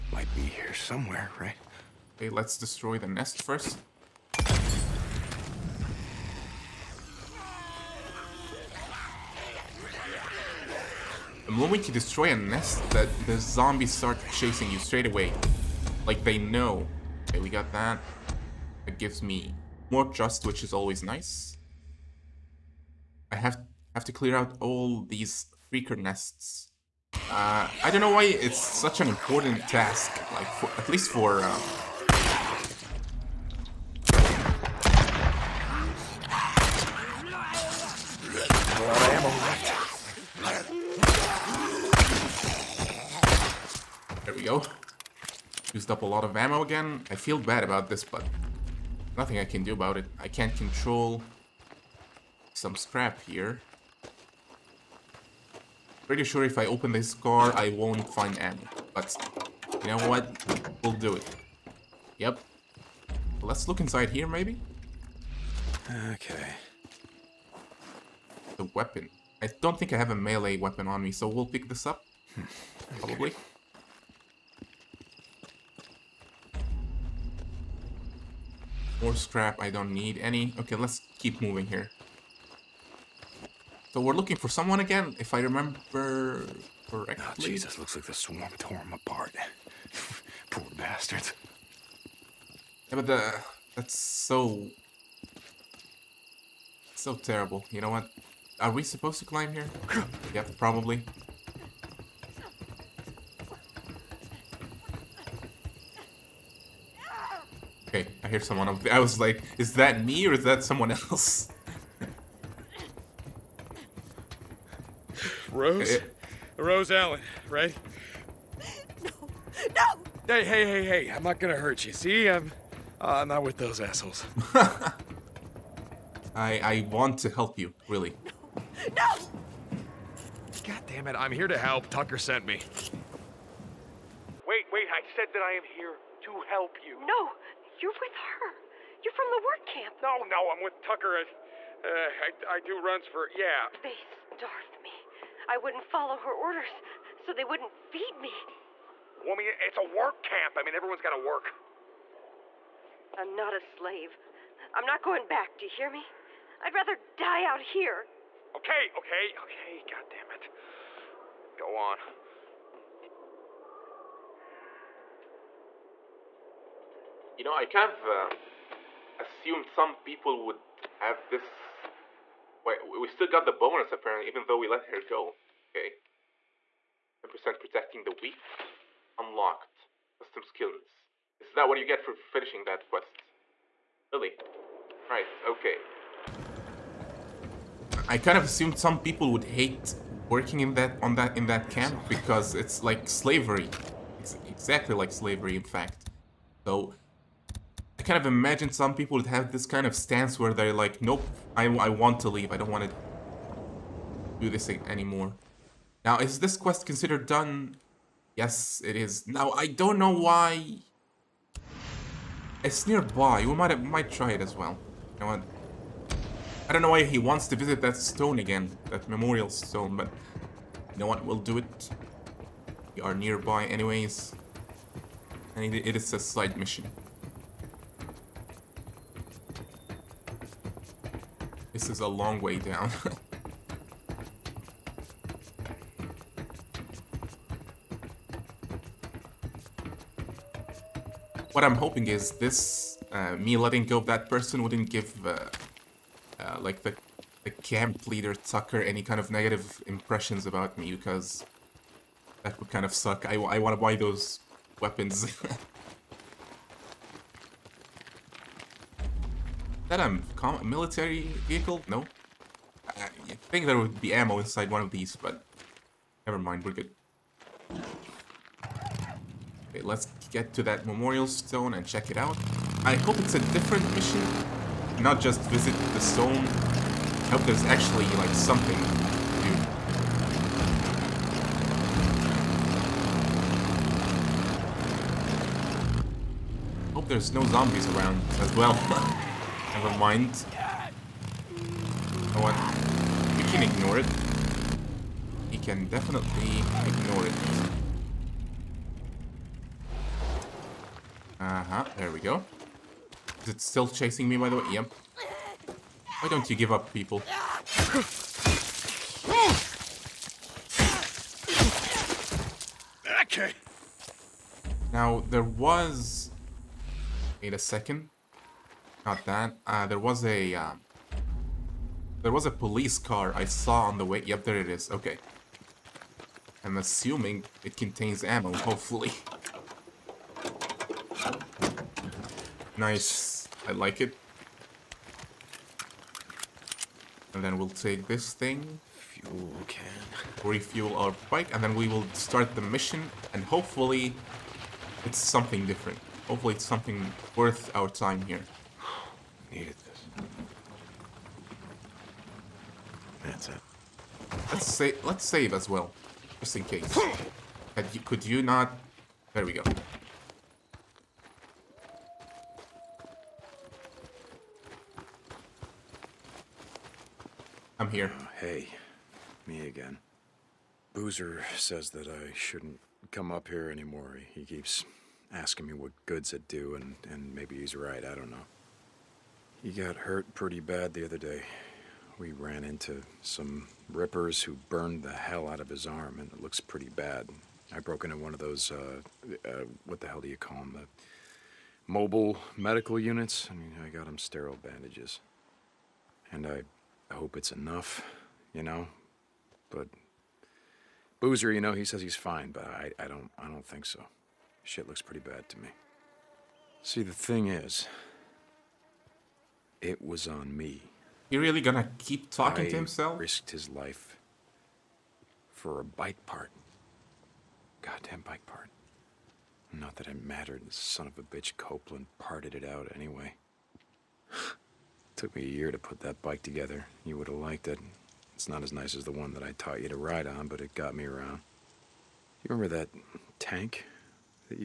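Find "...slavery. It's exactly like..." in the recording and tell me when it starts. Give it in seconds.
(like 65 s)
193 s.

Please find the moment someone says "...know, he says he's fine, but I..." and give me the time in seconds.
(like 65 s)
401 s.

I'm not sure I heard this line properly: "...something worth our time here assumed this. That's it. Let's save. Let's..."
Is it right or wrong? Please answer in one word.
wrong.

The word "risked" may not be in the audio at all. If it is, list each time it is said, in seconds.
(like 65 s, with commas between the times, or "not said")
413 s.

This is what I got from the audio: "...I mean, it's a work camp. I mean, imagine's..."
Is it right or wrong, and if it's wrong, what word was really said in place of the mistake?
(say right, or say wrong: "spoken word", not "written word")
wrong: "everyone", not "imagine".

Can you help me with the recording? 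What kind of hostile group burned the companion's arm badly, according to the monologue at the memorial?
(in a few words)
Rippers.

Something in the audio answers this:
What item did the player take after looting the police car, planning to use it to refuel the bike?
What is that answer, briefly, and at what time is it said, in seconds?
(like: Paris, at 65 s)
Fuel can, at 338 s.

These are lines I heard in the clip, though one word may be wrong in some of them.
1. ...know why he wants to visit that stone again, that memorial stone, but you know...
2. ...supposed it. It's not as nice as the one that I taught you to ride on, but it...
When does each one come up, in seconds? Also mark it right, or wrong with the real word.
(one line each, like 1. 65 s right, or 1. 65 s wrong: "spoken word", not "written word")
1. 216 s right
2. 427 s wrong: "liked", not "supposed".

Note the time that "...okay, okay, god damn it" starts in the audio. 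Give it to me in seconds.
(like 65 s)
158 s.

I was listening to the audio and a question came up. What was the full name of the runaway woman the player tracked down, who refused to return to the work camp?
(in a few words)
Rose Allen.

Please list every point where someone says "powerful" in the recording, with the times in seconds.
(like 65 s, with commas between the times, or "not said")
not said.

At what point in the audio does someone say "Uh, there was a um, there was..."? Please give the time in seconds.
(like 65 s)
319 s.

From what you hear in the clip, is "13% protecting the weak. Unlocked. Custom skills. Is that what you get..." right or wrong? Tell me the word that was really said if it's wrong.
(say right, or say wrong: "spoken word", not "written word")
wrong: "10", not "13".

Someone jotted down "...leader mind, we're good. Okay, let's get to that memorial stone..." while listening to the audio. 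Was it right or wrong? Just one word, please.
wrong.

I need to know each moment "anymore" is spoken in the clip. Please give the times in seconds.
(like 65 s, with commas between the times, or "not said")
204 s, 373 s.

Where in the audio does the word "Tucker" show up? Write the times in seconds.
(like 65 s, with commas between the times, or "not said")
131 s, 140 s, 248 s.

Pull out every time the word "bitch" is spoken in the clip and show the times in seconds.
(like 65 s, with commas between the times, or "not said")
421 s.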